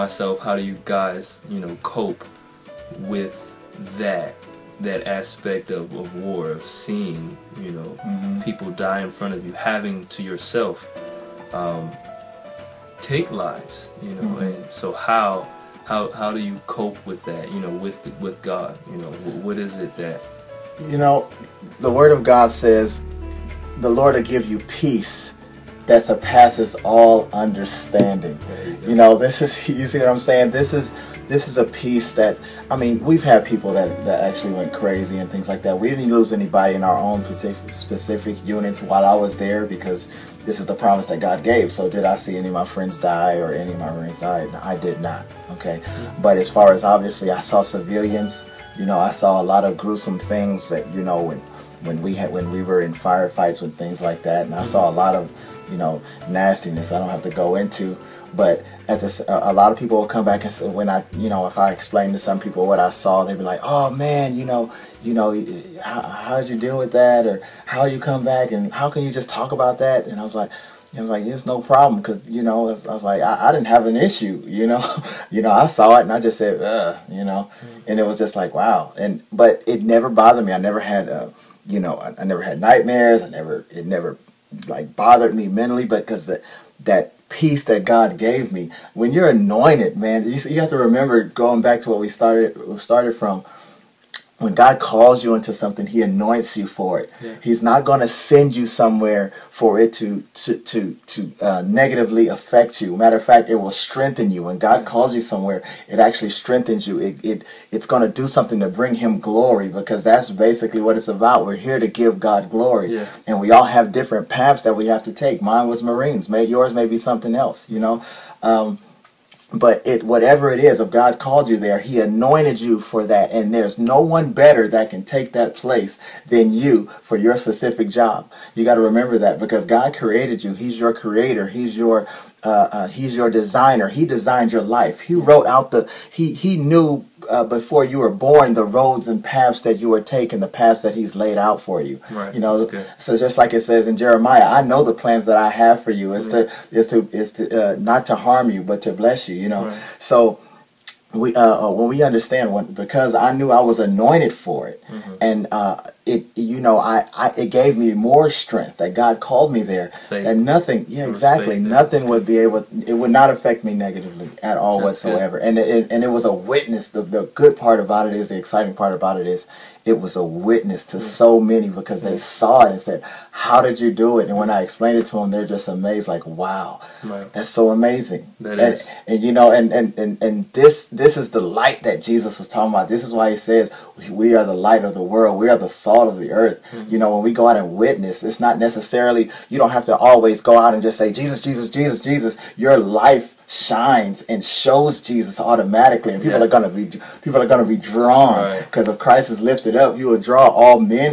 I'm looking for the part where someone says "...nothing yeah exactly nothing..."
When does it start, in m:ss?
2:40.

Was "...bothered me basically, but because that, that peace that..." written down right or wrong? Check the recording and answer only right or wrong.
wrong.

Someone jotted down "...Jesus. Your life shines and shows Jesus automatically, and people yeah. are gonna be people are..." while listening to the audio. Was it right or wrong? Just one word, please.
right.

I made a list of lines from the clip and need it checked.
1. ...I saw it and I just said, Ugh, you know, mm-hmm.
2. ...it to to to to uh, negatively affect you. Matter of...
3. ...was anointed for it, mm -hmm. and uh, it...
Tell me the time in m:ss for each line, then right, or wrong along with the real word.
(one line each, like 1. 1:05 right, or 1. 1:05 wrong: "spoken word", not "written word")
1. 1:15 right
2. 1:39 right
3. 2:33 right.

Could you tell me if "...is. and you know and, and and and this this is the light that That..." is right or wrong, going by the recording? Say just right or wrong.
wrong.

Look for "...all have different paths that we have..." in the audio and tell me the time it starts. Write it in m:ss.
1:53.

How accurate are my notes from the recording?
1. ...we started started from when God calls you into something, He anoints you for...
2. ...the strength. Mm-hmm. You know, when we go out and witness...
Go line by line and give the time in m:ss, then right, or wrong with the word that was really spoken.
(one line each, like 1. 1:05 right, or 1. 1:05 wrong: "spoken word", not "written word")
1. 1:31 right
2. 3:06 wrong: "earth", not "strength".